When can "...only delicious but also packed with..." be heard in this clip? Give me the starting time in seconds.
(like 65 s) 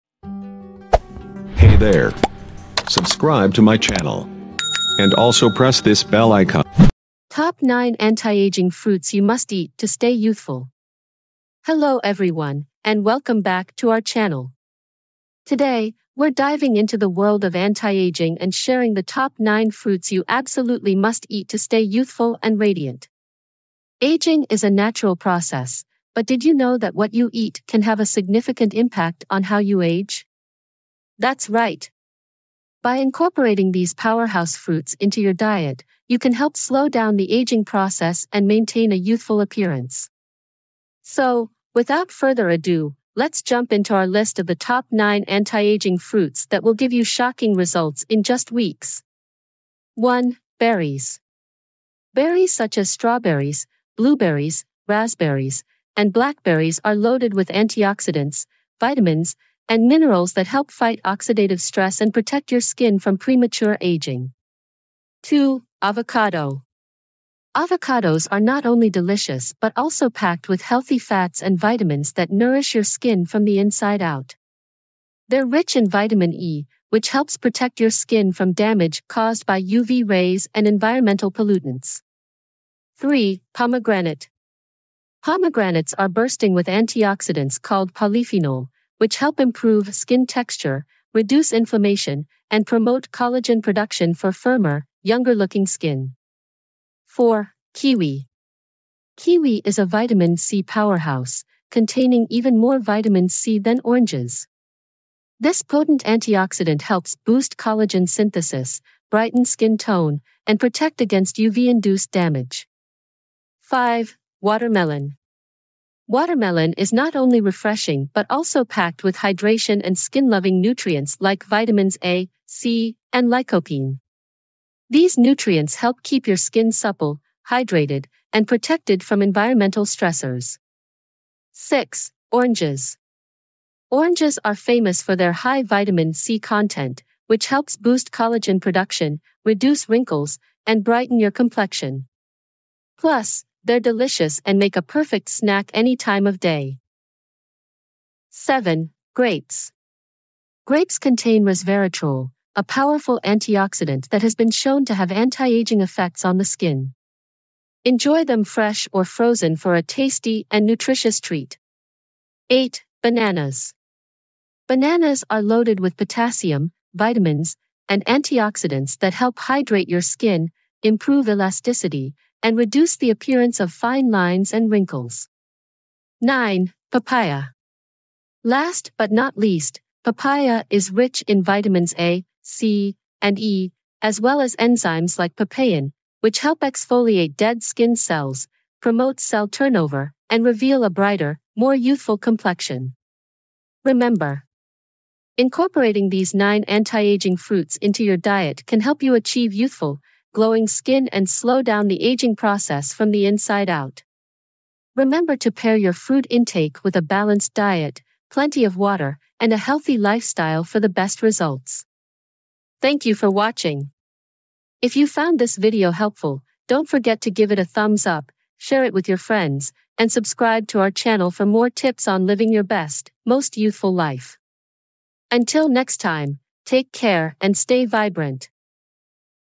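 68 s.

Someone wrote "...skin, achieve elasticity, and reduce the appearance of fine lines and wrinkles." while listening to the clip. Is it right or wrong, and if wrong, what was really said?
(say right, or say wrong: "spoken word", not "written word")
wrong: "improve", not "achieve".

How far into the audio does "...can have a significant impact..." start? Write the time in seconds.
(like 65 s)
27 s.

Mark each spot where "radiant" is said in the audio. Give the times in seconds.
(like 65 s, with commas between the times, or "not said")
22 s.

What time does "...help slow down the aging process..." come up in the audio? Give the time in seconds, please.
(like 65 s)
36 s.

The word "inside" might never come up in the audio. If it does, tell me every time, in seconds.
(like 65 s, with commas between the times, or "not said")
73 s, 203 s.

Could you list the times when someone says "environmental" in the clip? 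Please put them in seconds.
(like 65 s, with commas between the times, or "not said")
80 s, 129 s.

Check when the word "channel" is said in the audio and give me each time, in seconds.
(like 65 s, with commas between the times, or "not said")
3 s, 14 s, 220 s.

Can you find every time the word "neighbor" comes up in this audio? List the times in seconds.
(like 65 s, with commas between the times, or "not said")
not said.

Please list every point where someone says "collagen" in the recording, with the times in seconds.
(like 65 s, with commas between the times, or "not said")
93 s, 107 s, 138 s.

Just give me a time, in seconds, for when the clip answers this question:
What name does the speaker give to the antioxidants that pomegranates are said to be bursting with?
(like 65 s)
87 s.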